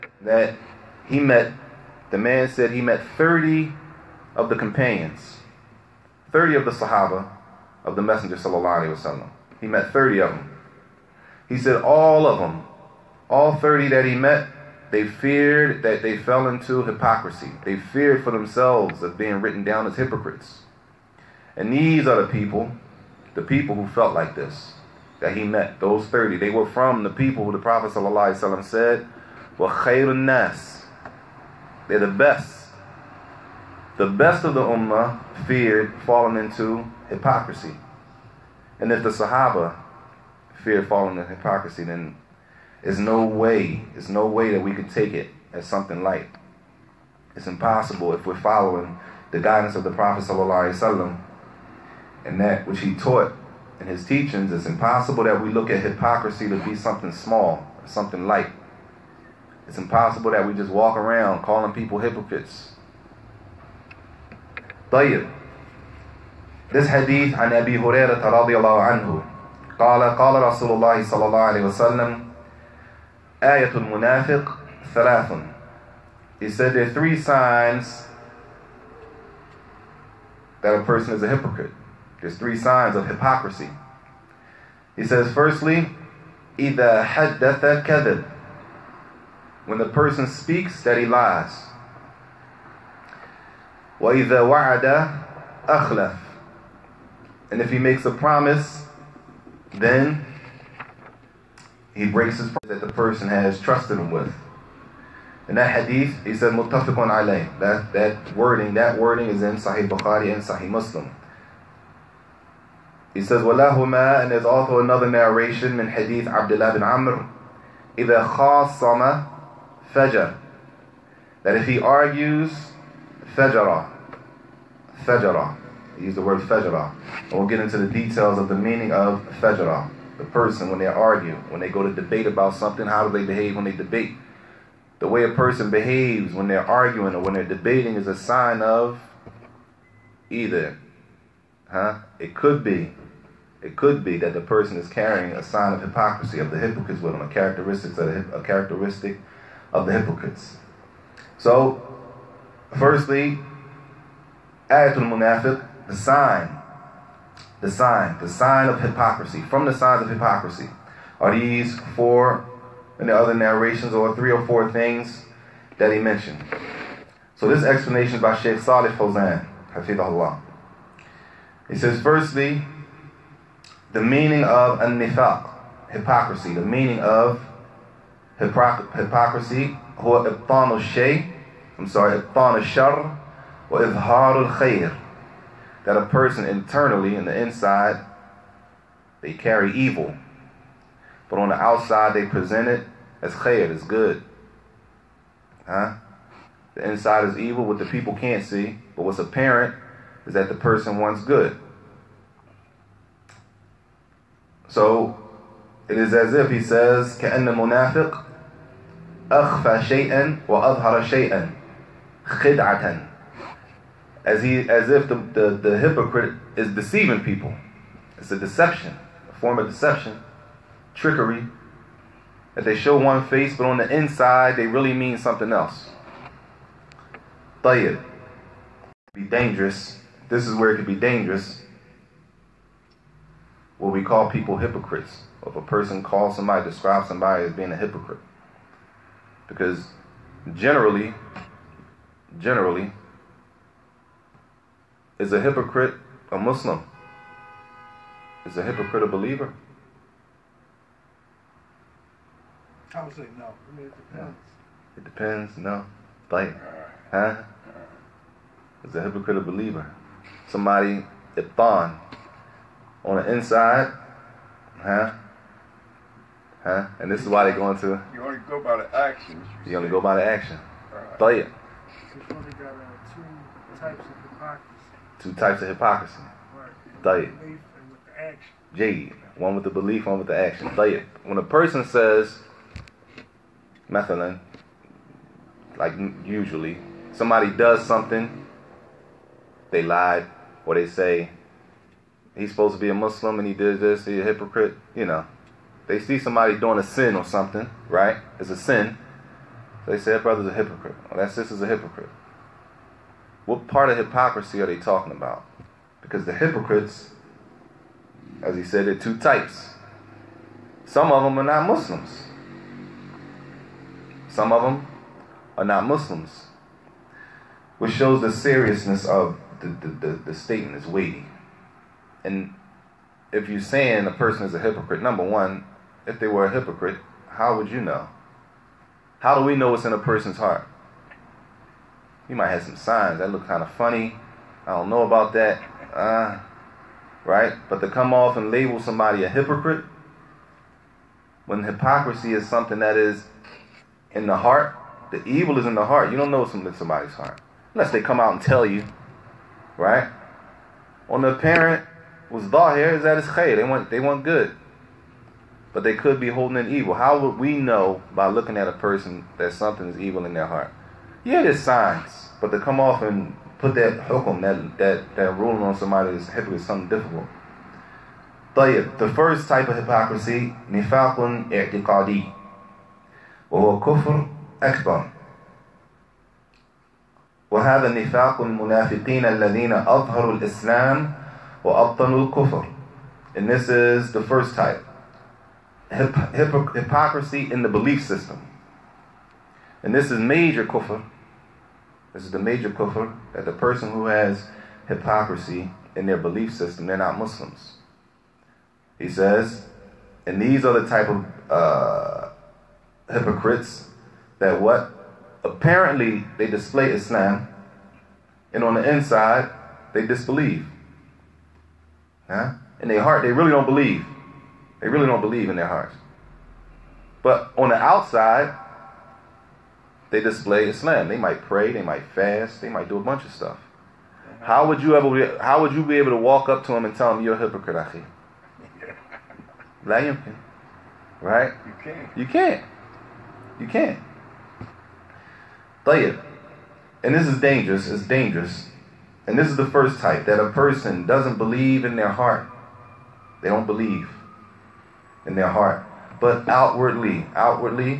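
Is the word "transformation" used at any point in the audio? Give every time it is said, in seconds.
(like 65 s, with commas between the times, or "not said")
not said.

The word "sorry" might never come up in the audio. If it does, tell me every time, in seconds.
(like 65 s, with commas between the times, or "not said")
181 s.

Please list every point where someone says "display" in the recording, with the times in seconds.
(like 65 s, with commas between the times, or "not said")
406 s, 420 s.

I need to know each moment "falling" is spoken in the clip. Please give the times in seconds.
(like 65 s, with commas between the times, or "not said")
36 s, 40 s.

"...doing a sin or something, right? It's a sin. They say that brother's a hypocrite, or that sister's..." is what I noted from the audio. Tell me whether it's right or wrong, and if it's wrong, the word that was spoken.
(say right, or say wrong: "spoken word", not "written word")
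right.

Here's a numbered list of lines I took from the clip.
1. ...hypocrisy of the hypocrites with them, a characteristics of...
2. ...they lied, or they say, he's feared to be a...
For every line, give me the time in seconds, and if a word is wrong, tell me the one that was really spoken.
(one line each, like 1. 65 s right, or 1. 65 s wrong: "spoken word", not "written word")
1. 145 s right
2. 289 s wrong: "supposed", not "feared".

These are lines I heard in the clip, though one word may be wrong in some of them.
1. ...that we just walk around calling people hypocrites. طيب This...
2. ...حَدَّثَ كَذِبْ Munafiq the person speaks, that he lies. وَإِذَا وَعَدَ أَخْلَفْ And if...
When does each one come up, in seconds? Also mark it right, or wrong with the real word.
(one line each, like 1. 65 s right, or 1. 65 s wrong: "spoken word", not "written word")
1. 60 s right
2. 87 s wrong: "When", not "Munafiq".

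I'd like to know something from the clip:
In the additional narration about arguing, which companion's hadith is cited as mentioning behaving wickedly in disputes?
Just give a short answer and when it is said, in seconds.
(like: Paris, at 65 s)
Abdullah bin Amr, at 116 s.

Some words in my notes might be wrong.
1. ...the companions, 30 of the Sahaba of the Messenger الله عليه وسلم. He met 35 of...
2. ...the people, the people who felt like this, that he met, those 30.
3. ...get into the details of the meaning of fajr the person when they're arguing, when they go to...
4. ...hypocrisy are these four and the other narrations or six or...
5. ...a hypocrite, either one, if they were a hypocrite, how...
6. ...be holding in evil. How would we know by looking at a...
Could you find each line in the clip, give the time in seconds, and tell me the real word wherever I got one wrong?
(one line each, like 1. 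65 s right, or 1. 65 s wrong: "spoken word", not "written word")
1. 4 s wrong: "30", not "35"
2. 22 s right
3. 127 s right
4. 160 s wrong: "three", not "six"
5. 324 s wrong: "number", not "either"
6. 356 s right.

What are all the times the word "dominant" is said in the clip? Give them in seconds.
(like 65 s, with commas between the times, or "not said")
not said.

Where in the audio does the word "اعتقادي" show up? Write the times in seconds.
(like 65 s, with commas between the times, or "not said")
371 s.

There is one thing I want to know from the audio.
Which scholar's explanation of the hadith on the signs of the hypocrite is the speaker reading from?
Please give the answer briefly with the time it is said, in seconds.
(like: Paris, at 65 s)
Sheikh Salih Fawzan, at 168 s.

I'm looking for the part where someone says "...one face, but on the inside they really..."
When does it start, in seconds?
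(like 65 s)
222 s.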